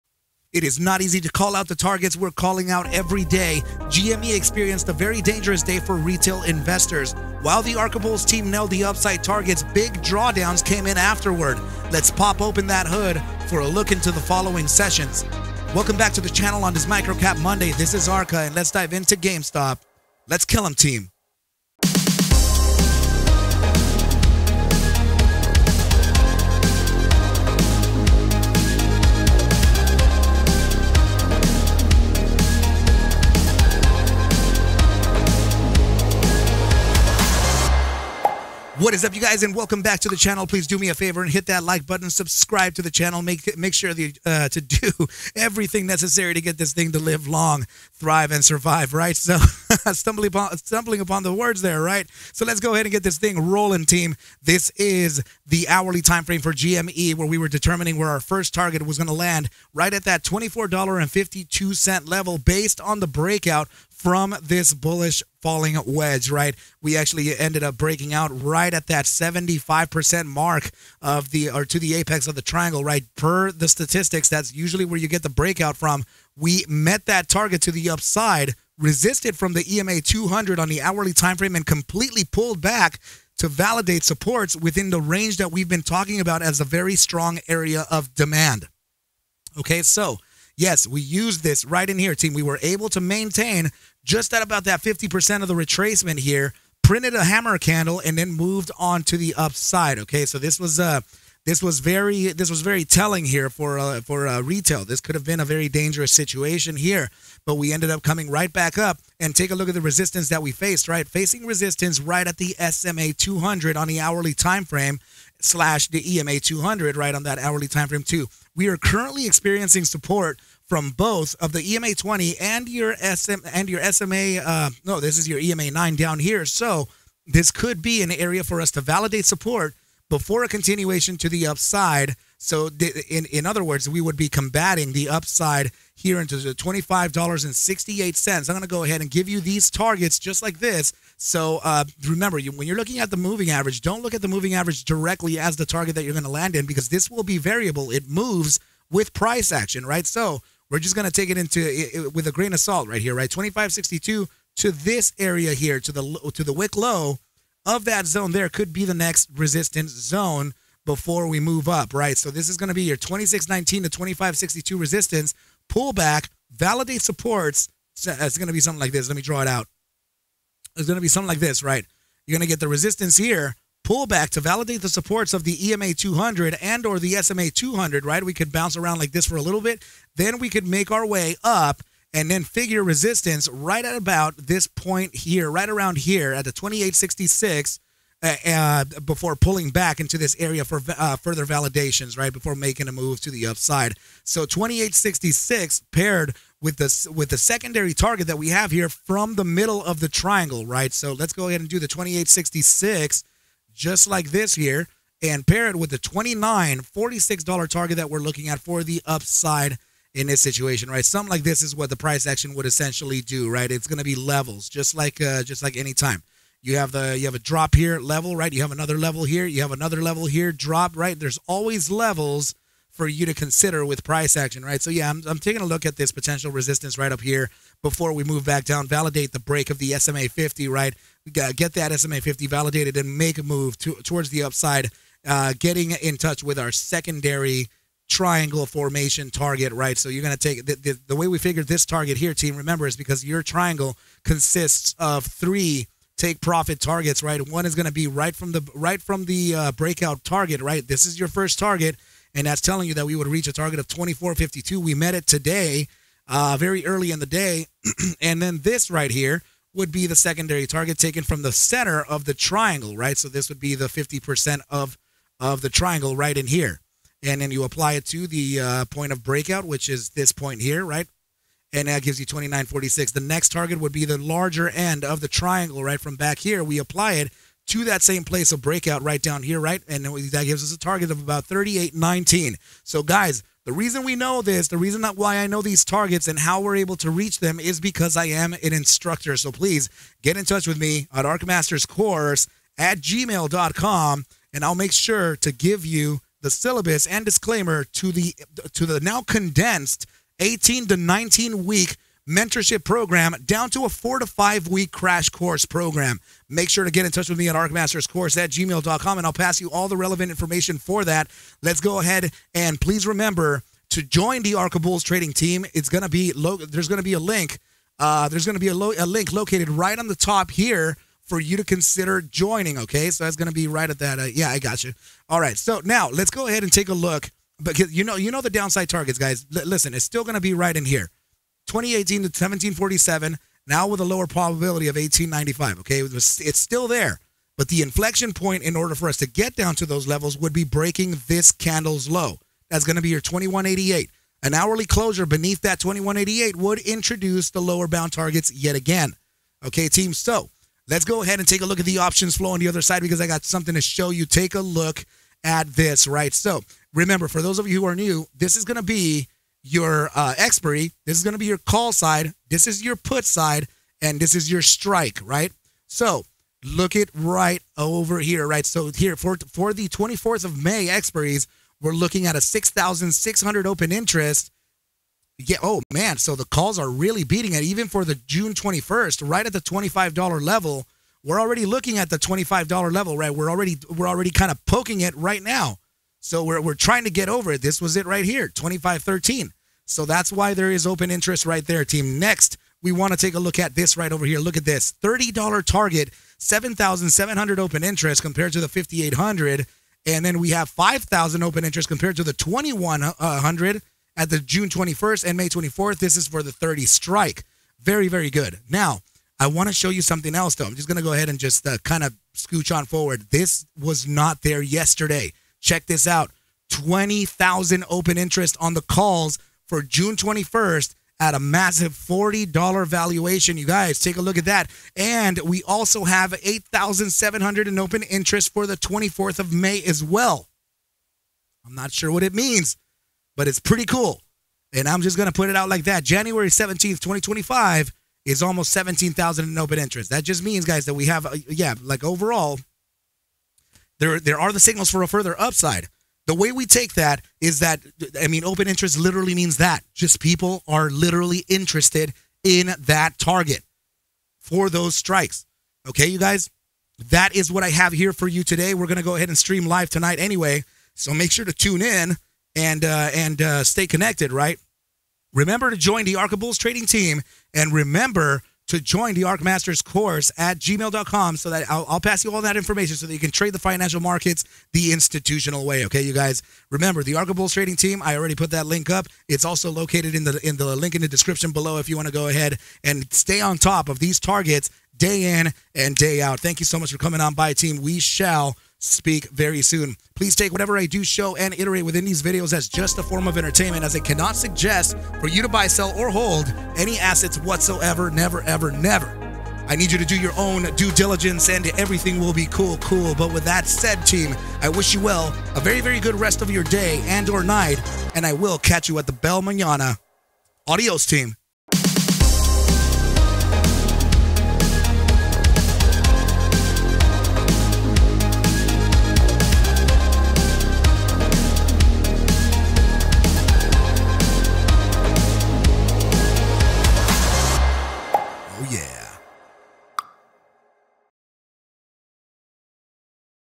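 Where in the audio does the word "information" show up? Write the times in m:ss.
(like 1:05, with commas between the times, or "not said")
5:10, 7:52.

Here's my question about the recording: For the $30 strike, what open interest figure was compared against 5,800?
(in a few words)
7,700.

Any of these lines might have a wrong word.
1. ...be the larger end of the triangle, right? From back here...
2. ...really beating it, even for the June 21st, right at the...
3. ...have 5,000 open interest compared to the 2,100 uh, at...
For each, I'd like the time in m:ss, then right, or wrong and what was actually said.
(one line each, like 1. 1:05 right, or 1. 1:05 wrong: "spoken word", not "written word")
1. 4:33 right
2. 6:16 right
3. 6:40 right.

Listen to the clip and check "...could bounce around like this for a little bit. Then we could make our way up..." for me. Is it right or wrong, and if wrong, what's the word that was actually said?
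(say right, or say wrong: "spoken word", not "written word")
right.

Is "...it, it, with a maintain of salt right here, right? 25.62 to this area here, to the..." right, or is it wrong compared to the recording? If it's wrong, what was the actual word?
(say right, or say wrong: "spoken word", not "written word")
wrong: "grain", not "maintain".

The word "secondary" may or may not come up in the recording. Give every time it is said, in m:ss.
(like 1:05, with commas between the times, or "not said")
3:17, 3:56, 4:20.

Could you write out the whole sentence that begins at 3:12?
Before making a move to the upside.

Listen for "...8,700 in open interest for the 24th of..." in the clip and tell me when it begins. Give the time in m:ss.
7:06.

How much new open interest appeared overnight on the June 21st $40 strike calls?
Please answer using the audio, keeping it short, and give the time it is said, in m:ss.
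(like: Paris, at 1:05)
20,000, at 6:56.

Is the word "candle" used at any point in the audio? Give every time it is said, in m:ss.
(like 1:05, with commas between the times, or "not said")
1:37, 5:41.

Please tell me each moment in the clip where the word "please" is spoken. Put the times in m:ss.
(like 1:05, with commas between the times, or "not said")
0:40, 4:49, 5:12, 8:10.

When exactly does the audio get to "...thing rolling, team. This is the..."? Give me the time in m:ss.
0:53.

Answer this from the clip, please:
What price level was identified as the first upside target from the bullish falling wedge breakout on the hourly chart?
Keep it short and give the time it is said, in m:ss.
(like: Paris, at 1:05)
$24.52, at 1:00.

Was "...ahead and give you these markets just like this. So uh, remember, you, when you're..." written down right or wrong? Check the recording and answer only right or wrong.
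wrong.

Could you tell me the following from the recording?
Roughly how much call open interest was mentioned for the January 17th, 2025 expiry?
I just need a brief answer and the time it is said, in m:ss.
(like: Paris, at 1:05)
Almost 17,000, at 7:18.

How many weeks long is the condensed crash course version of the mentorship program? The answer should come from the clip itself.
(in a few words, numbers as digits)
4 to 5 weeks.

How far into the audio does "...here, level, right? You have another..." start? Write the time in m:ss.
3:37.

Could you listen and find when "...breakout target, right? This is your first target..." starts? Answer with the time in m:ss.
4:09.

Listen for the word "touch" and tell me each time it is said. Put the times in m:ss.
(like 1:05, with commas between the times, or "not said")
3:56, 4:50, 5:07.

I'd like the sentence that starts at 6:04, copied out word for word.
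And this is your strike, right?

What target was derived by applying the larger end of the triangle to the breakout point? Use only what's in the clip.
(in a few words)
38.19.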